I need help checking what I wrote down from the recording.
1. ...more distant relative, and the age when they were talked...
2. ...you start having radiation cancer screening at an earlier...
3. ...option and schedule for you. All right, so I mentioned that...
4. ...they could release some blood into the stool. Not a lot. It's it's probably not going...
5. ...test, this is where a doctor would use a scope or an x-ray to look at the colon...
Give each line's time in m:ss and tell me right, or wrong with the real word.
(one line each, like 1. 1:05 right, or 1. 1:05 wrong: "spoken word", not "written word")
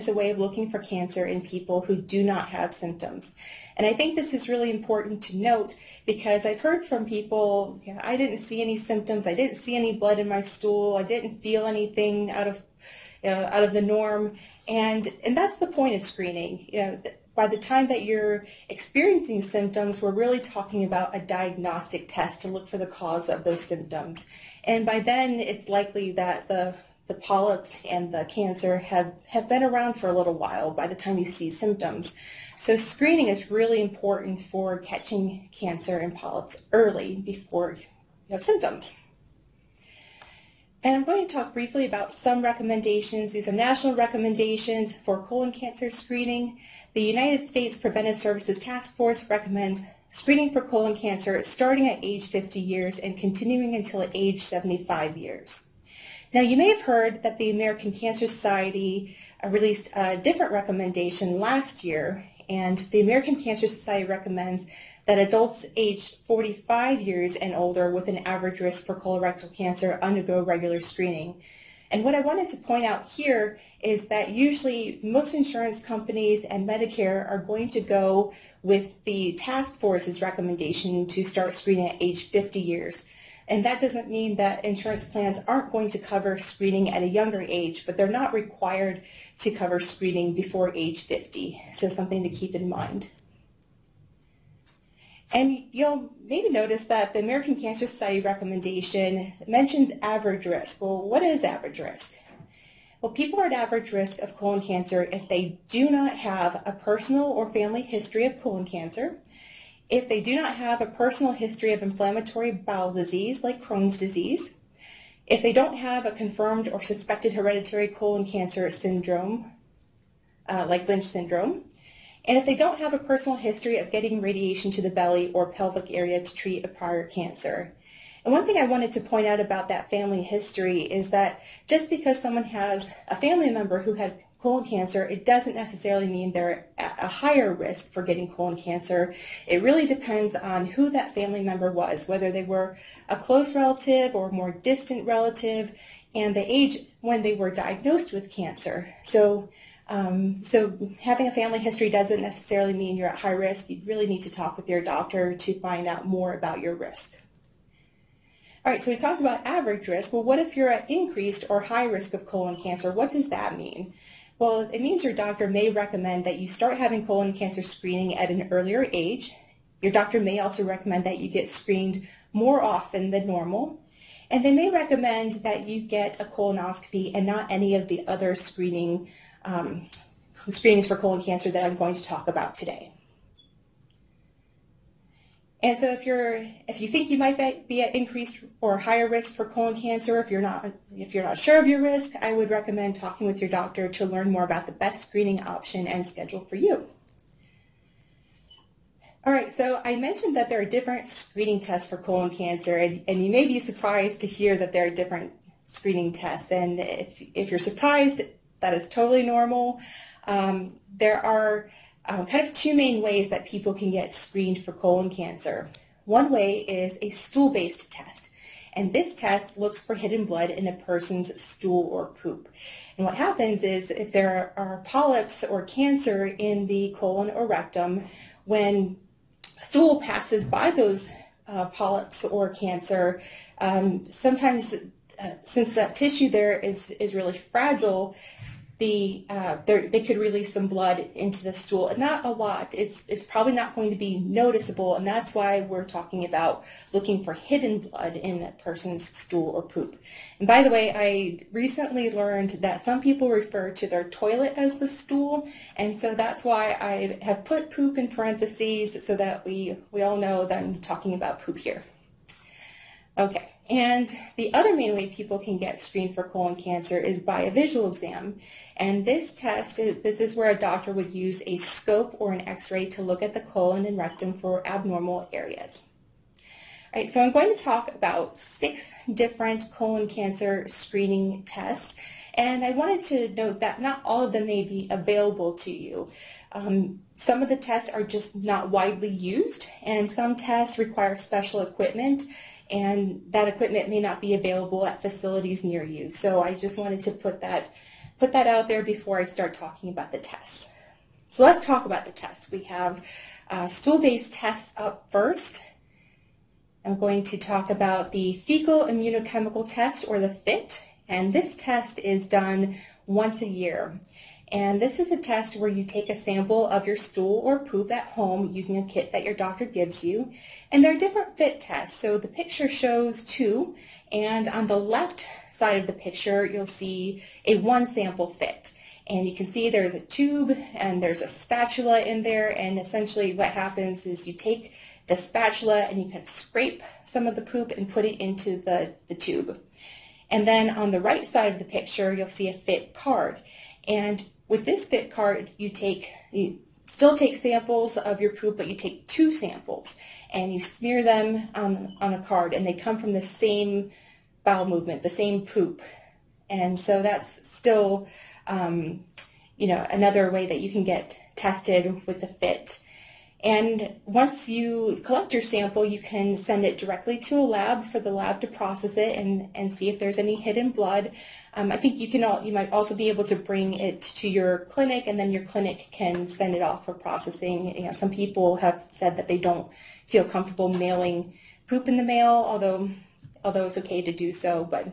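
1. 2:24 wrong: "diagnosed", not "talked"
2. 2:46 wrong: "colon", not "radiation"
3. 3:15 right
4. 3:59 right
5. 4:29 right.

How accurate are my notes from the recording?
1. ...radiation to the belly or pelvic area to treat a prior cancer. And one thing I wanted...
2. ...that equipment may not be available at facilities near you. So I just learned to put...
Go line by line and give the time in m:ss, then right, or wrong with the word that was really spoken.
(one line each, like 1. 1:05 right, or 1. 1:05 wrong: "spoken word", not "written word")
1. 2:04 right
2. 4:53 wrong: "wanted", not "learned".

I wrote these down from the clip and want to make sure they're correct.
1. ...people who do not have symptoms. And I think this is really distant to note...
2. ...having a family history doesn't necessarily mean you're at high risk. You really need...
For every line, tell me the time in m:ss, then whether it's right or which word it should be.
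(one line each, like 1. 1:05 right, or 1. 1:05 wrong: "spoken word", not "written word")
1. 0:01 wrong: "important", not "distant"
2. 2:30 right.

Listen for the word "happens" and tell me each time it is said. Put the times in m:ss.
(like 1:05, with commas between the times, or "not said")
3:43, 5:33.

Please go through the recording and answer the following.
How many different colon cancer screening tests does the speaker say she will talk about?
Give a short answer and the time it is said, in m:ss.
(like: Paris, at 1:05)
6, at 4:38.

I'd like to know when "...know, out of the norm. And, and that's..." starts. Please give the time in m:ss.
0:13.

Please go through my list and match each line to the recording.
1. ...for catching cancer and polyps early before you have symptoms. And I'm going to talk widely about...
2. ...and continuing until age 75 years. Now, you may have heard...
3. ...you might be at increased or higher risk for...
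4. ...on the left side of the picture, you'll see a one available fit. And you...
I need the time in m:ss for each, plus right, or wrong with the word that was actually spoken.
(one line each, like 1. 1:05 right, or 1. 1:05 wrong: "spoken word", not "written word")
1. 0:34 wrong: "briefly", not "widely"
2. 0:52 right
3. 3:07 right
4. 5:24 wrong: "sample", not "available".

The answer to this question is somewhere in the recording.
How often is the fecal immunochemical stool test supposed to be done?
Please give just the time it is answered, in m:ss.
5:13.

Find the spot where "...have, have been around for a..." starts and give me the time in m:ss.
0:28.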